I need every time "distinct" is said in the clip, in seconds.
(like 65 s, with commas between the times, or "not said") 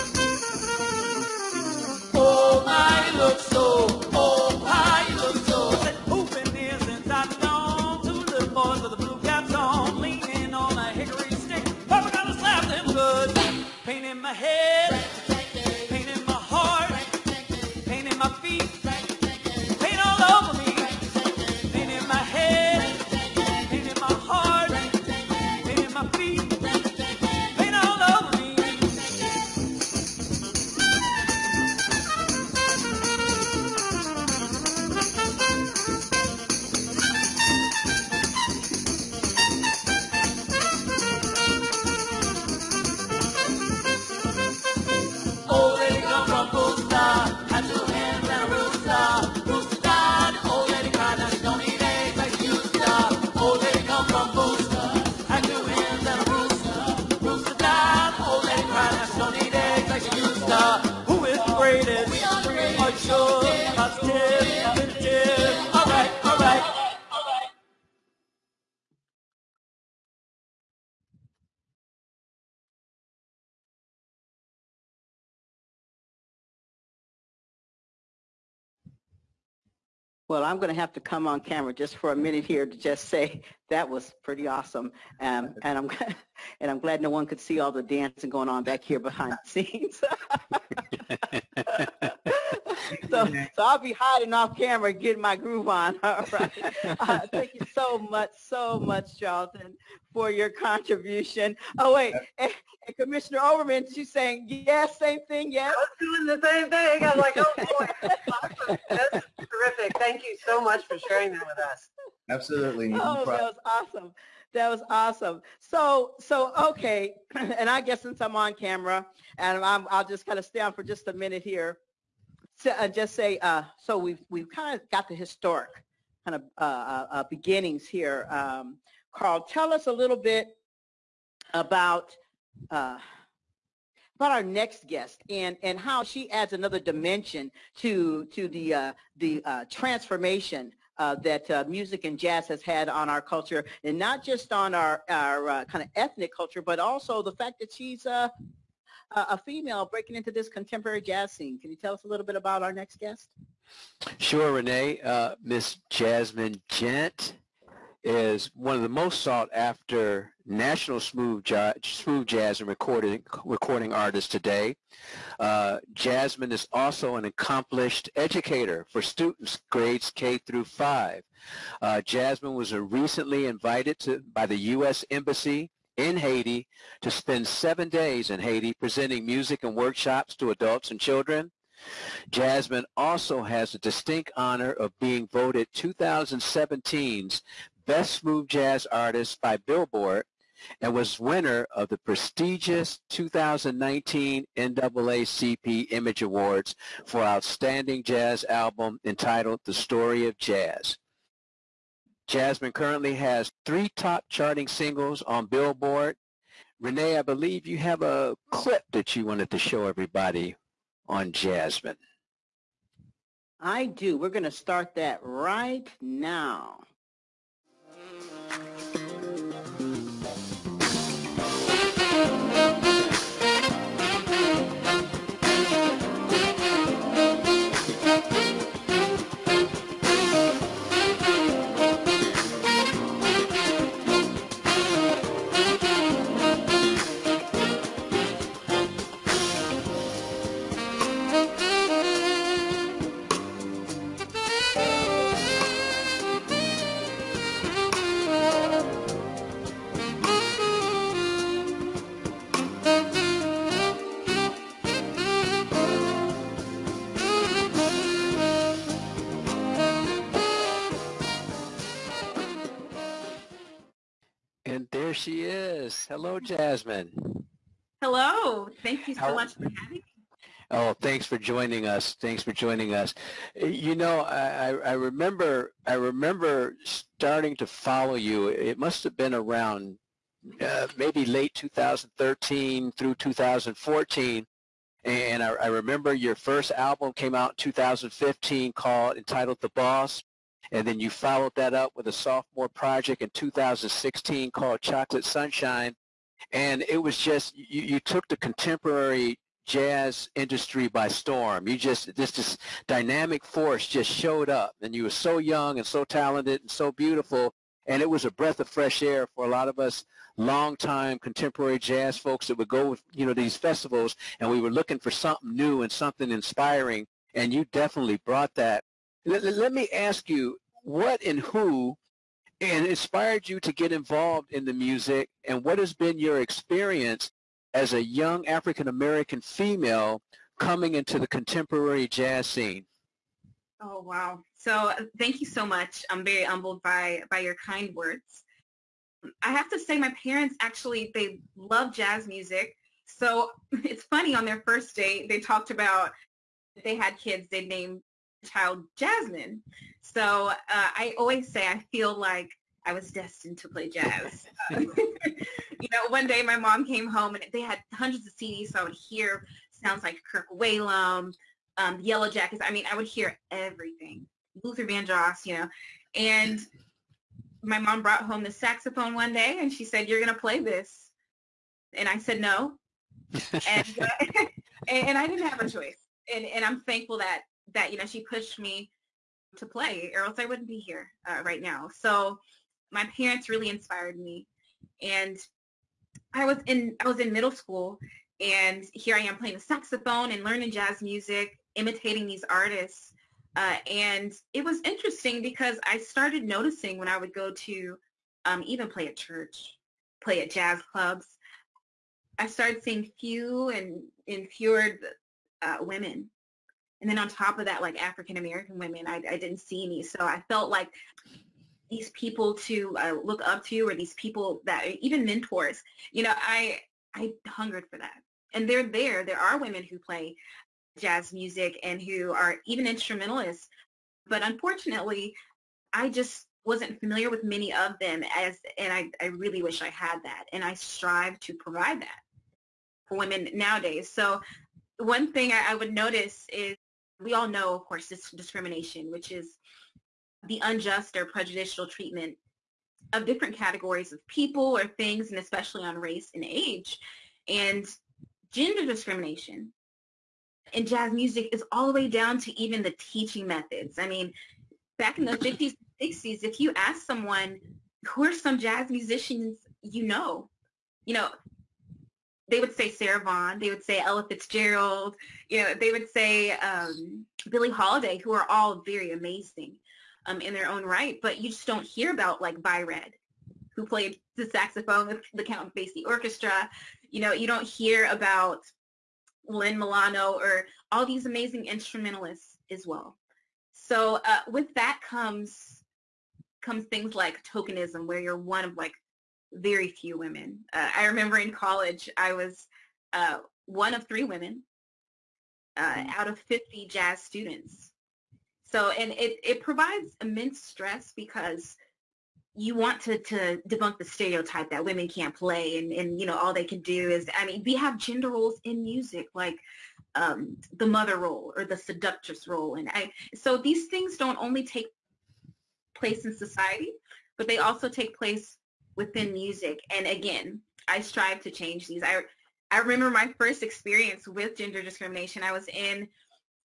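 183 s.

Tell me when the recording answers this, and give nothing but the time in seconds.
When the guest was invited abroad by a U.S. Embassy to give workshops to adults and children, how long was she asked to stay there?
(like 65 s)
177 s.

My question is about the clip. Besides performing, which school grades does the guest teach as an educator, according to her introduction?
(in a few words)
K through 5.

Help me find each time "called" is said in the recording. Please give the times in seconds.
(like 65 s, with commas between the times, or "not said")
288 s, 294 s.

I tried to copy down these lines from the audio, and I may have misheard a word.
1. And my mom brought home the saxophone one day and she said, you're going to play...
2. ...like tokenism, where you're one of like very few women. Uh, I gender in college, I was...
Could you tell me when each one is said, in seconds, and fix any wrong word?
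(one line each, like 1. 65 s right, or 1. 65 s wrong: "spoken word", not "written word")
1. 366 s right
2. 487 s wrong: "remember", not "gender".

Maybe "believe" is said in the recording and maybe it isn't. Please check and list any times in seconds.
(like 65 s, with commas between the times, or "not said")
207 s.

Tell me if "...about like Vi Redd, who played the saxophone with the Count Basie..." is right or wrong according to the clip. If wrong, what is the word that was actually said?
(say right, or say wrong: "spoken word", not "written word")
right.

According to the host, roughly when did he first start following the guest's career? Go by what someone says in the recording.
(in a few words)
late 2013.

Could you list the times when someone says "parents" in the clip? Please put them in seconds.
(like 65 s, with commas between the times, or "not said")
340 s, 383 s.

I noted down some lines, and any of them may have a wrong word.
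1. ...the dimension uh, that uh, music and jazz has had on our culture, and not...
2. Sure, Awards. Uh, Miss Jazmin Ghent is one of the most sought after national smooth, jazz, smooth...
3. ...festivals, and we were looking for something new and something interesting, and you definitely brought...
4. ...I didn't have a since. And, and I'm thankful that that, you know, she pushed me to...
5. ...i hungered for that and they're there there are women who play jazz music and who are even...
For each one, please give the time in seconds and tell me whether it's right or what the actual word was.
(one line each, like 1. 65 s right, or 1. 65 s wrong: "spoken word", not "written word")
1. 139 s wrong: "transformation", not "dimension"
2. 154 s wrong: "Renee", not "Awards"
3. 313 s wrong: "inspiring", not "interesting"
4. 375 s wrong: "choice", not "since"
5. 417 s right.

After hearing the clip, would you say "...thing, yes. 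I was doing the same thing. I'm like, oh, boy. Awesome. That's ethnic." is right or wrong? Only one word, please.
wrong.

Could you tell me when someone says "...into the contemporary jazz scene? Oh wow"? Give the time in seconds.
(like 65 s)
330 s.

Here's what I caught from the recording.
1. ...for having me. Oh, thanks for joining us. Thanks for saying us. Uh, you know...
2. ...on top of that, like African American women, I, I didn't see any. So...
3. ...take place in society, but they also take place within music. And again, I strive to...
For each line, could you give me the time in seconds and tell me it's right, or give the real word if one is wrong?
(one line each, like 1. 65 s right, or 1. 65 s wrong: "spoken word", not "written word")
1. 269 s wrong: "joining", not "saying"
2. 407 s right
3. 514 s right.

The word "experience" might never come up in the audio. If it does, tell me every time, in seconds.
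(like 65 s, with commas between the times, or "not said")
326 s, 523 s.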